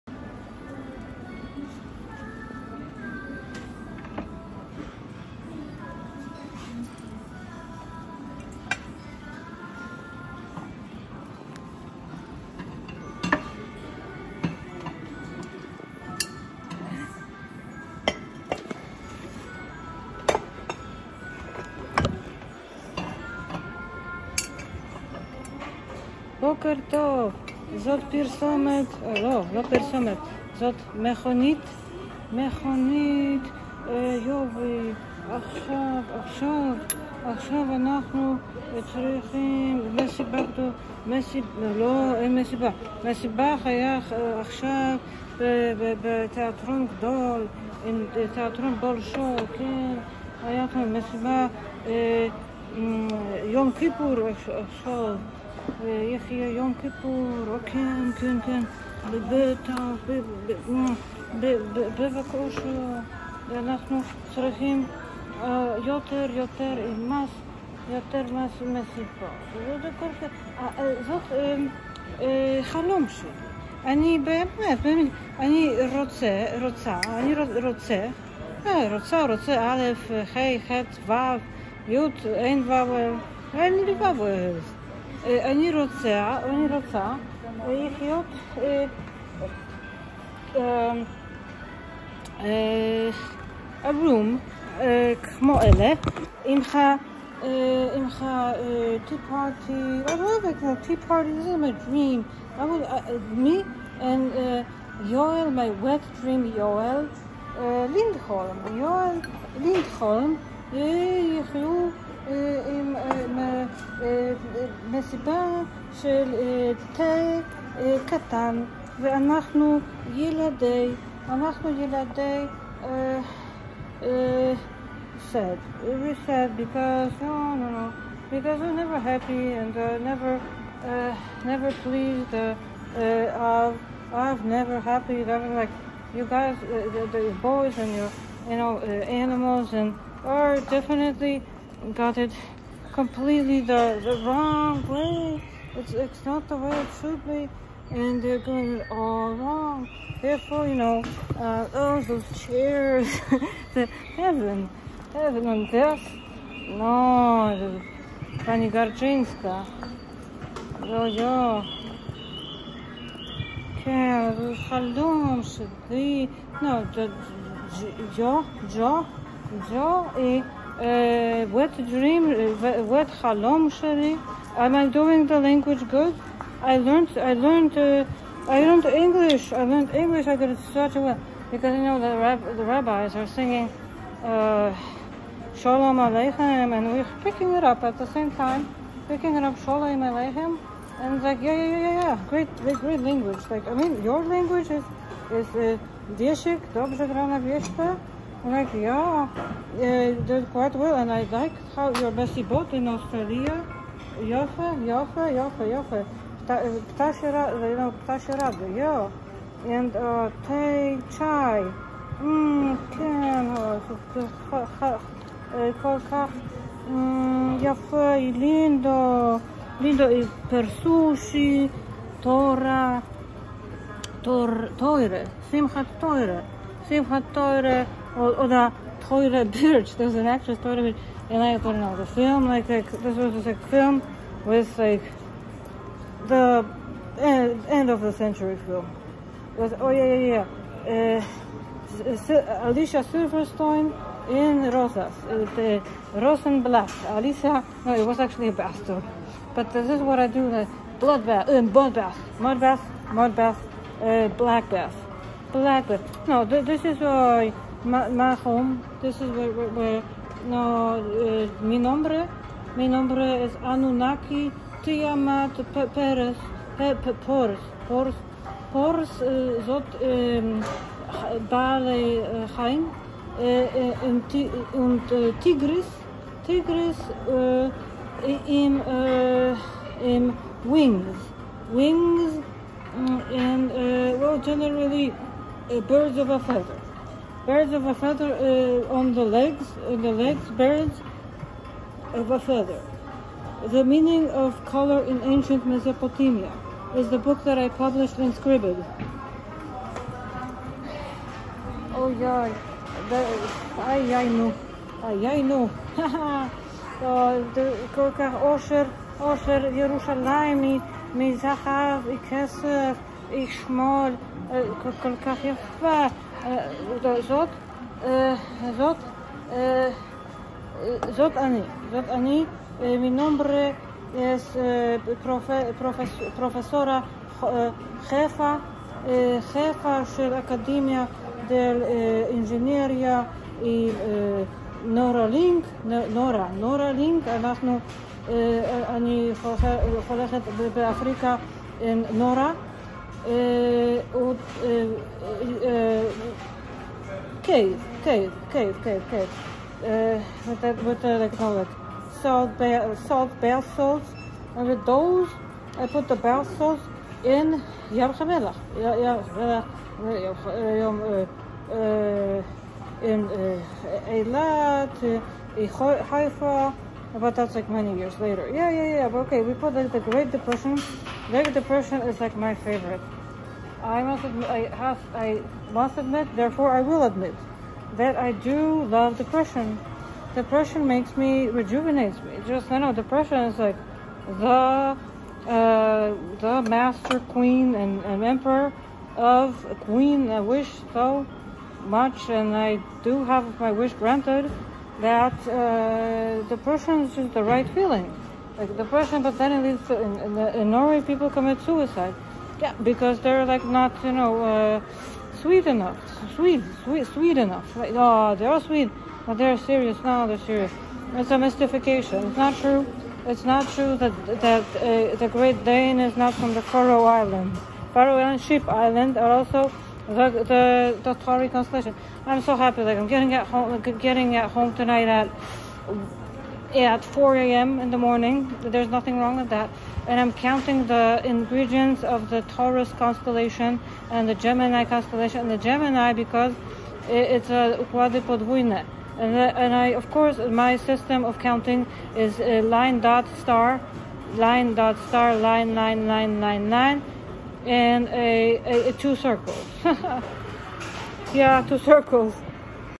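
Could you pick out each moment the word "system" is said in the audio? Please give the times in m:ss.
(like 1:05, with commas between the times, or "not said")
7:20.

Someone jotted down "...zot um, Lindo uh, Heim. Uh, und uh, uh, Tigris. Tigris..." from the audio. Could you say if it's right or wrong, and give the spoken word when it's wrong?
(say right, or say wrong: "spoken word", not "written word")
wrong: "Bale", not "Lindo".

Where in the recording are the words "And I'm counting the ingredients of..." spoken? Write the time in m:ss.
7:10.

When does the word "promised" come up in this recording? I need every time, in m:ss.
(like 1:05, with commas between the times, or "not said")
not said.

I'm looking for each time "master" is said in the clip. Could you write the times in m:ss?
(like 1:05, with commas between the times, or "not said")
6:26.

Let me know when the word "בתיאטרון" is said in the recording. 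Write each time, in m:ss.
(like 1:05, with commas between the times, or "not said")
0:46.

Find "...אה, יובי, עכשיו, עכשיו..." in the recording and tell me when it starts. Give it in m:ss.
0:33.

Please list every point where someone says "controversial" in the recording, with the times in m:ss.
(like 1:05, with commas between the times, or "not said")
not said.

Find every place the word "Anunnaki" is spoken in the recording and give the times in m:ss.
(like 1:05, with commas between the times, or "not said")
4:23.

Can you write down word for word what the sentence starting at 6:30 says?
I wish so much, and I do have my wish granted that uh, depression is just the right feeling.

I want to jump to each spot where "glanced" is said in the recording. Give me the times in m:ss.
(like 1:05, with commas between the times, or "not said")
not said.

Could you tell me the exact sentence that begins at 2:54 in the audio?
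Am I doing the language good?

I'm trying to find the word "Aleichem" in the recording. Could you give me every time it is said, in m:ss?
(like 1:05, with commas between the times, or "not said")
3:05, 3:10.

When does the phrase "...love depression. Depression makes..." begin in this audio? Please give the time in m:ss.
6:18.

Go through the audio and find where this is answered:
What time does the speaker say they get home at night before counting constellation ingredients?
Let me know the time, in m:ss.
7:07.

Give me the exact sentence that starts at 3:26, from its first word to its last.
Uh, ptasie uh, you know, ptasie yeah.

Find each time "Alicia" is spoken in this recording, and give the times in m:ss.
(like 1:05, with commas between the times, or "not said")
4:02, 4:07.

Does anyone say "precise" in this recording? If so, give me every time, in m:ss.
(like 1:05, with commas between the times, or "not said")
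not said.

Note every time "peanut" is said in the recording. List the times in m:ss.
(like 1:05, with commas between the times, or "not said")
not said.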